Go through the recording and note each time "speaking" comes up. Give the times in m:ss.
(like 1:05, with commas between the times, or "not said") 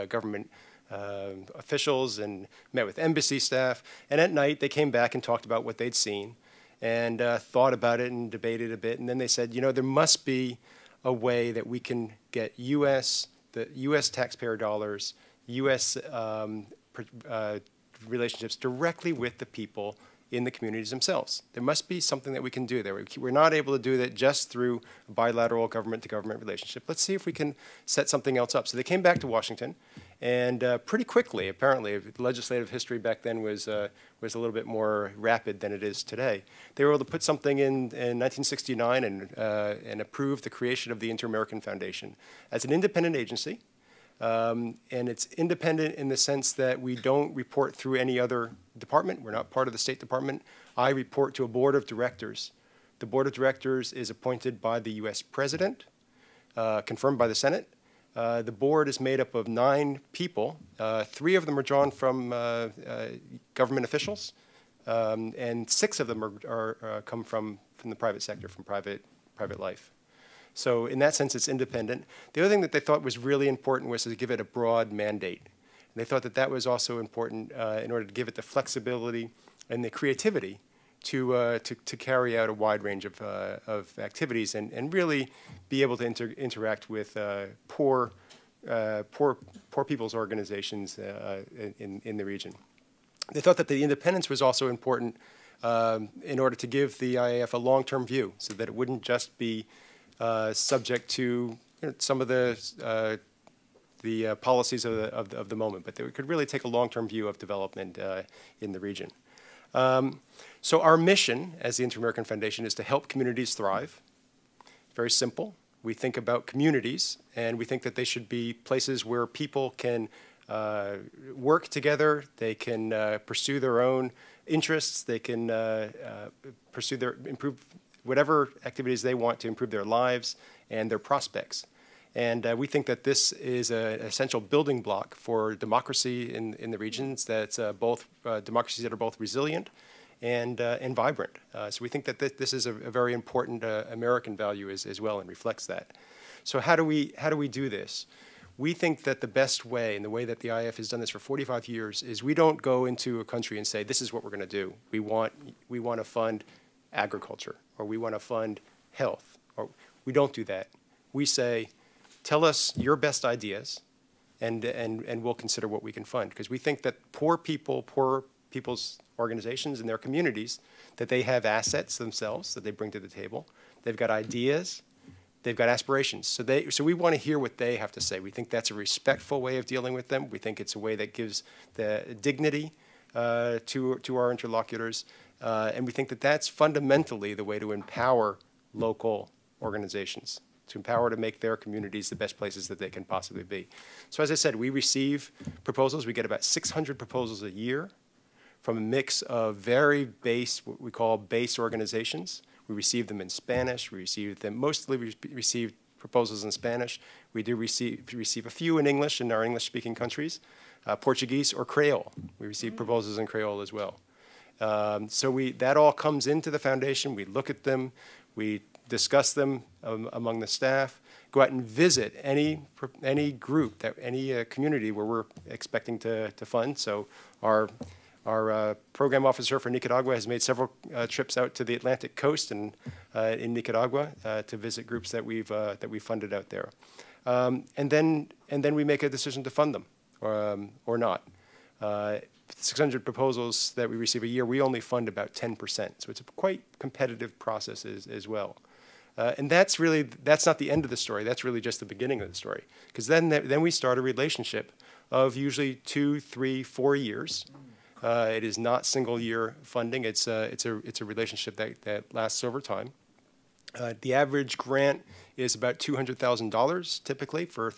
3:29.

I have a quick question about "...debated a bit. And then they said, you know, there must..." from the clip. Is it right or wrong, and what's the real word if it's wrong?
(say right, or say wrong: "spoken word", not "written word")
right.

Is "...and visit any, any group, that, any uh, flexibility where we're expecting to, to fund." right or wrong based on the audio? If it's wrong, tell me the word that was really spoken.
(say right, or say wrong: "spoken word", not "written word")
wrong: "community", not "flexibility".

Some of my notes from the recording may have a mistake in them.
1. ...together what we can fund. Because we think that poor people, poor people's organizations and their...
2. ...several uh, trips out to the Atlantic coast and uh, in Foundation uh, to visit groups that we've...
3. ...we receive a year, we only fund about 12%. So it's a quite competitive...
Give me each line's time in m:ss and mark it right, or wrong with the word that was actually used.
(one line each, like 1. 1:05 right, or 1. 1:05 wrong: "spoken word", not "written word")
1. 2:45 wrong: "consider", not "together"
2. 3:50 wrong: "Nicaragua", not "Foundation"
3. 4:03 wrong: "10", not "12".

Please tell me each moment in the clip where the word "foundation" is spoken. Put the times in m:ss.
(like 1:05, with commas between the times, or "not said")
0:41, 1:52, 3:36.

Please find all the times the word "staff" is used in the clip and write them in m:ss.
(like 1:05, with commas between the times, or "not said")
0:03, 3:40.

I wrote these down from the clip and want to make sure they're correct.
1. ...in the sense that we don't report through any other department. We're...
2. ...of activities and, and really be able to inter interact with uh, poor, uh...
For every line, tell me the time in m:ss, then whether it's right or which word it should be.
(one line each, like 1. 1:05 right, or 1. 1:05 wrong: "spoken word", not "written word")
1. 0:45 right
2. 1:23 right.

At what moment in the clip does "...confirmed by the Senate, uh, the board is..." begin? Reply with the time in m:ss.
0:56.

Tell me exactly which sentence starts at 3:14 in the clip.
So as I said, we receive proposals.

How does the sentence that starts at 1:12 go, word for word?
The other thing that they thought was really important was to give it a broad mandate.